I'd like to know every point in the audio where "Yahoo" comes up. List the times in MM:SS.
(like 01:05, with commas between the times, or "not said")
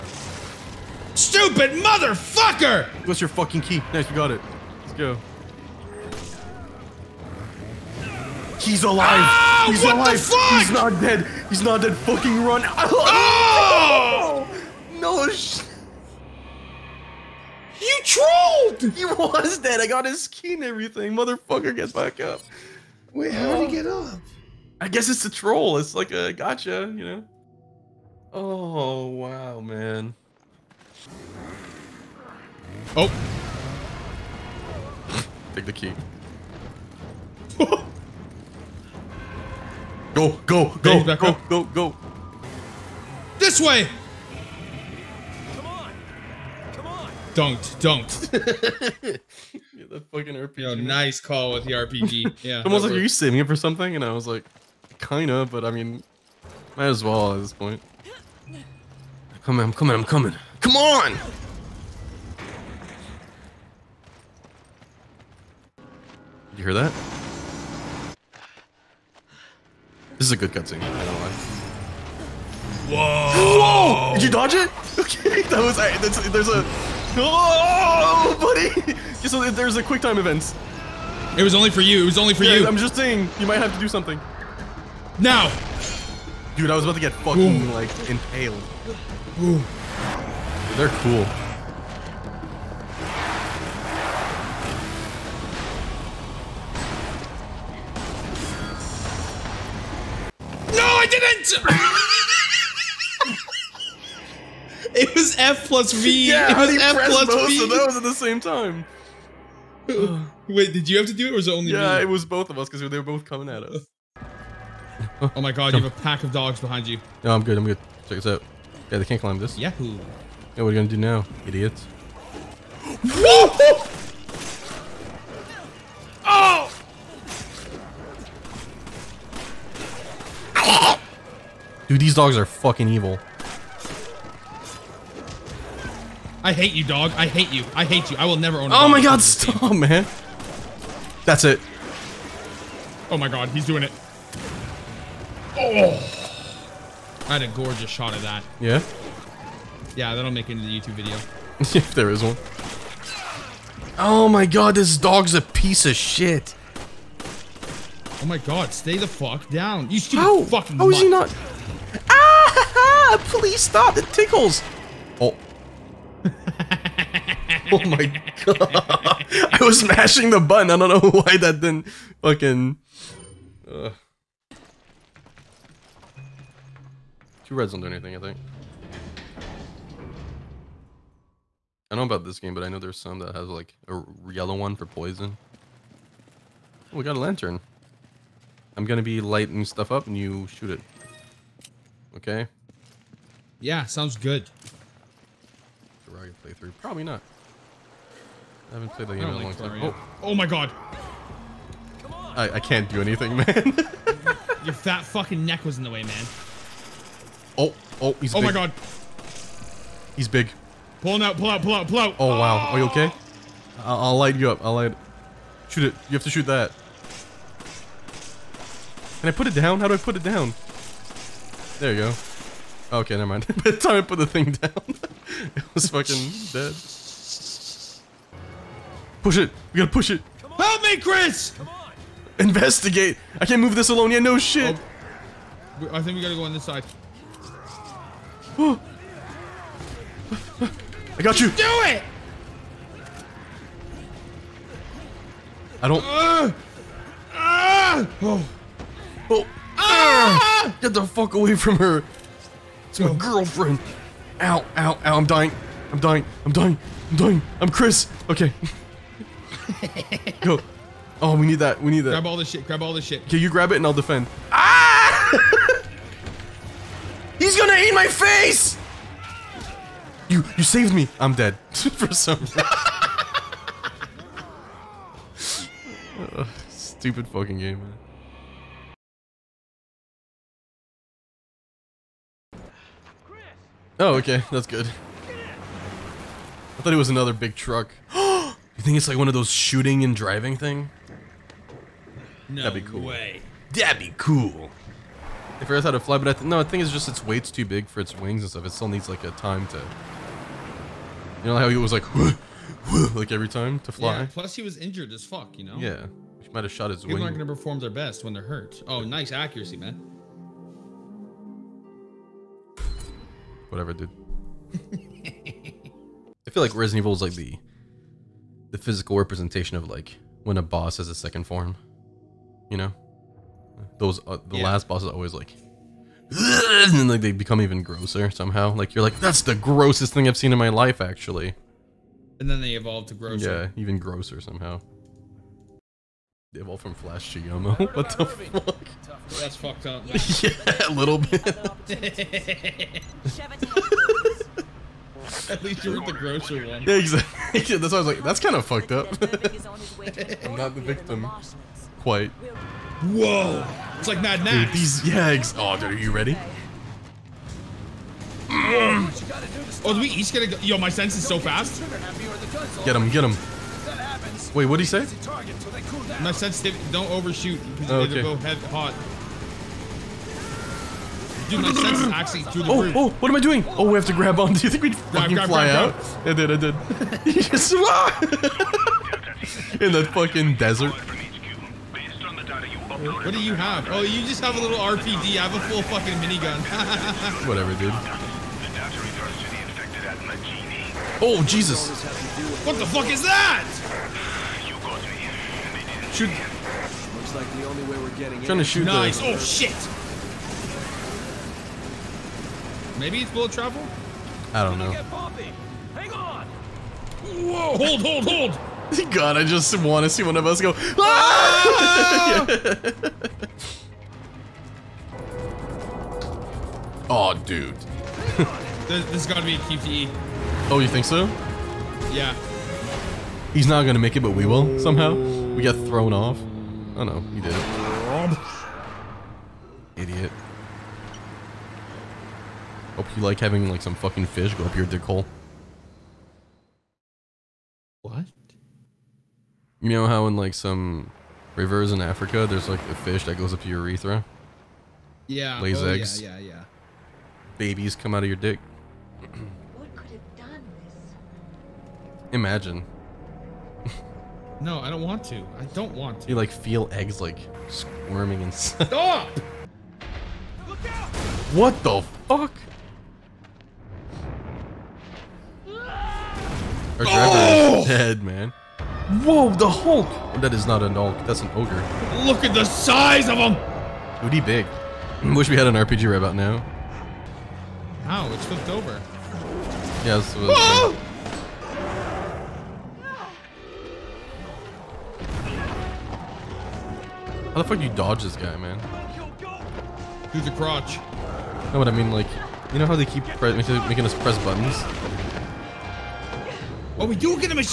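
01:59.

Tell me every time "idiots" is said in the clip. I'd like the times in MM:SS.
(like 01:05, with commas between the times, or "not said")
02:01, 07:10.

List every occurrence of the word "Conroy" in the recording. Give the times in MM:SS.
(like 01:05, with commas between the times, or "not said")
not said.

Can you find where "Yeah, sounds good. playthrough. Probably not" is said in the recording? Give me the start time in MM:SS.
03:13.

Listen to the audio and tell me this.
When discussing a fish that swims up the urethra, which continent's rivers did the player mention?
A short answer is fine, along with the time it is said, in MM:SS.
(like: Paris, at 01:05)
Africa, at 07:21.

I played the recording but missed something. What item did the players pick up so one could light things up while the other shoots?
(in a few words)
A lantern.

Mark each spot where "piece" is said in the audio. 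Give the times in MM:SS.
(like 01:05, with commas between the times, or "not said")
02:35.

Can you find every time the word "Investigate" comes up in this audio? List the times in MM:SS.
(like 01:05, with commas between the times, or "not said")
03:52.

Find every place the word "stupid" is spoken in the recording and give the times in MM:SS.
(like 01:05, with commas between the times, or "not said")
00:01, 02:39, 04:36.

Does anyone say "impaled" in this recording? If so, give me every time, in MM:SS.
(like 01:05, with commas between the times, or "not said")
01:28.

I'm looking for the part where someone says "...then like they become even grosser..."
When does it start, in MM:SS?
05:26.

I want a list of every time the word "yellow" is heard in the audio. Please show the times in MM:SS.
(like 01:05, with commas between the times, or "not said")
03:04.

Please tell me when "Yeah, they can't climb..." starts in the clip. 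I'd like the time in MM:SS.
01:58.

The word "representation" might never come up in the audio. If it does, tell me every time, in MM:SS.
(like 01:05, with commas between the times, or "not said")
05:19.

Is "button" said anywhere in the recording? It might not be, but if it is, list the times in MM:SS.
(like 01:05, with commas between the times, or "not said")
02:50, 08:14.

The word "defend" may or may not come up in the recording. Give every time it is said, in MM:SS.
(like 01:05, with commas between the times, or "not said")
04:23.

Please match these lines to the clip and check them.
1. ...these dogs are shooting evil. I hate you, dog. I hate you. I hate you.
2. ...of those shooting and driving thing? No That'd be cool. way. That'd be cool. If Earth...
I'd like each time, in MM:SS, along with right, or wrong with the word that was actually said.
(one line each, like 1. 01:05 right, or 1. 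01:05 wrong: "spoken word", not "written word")
1. 02:11 wrong: "fucking", not "shooting"
2. 04:49 right.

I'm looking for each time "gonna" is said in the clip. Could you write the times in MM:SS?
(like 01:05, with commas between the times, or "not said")
02:00, 03:08, 04:27, 05:07, 07:03.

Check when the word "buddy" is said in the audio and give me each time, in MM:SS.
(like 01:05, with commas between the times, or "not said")
01:18.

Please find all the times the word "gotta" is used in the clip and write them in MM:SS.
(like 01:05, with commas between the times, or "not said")
03:49, 03:56.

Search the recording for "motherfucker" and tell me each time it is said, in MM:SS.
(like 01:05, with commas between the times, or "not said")
00:01, 00:21.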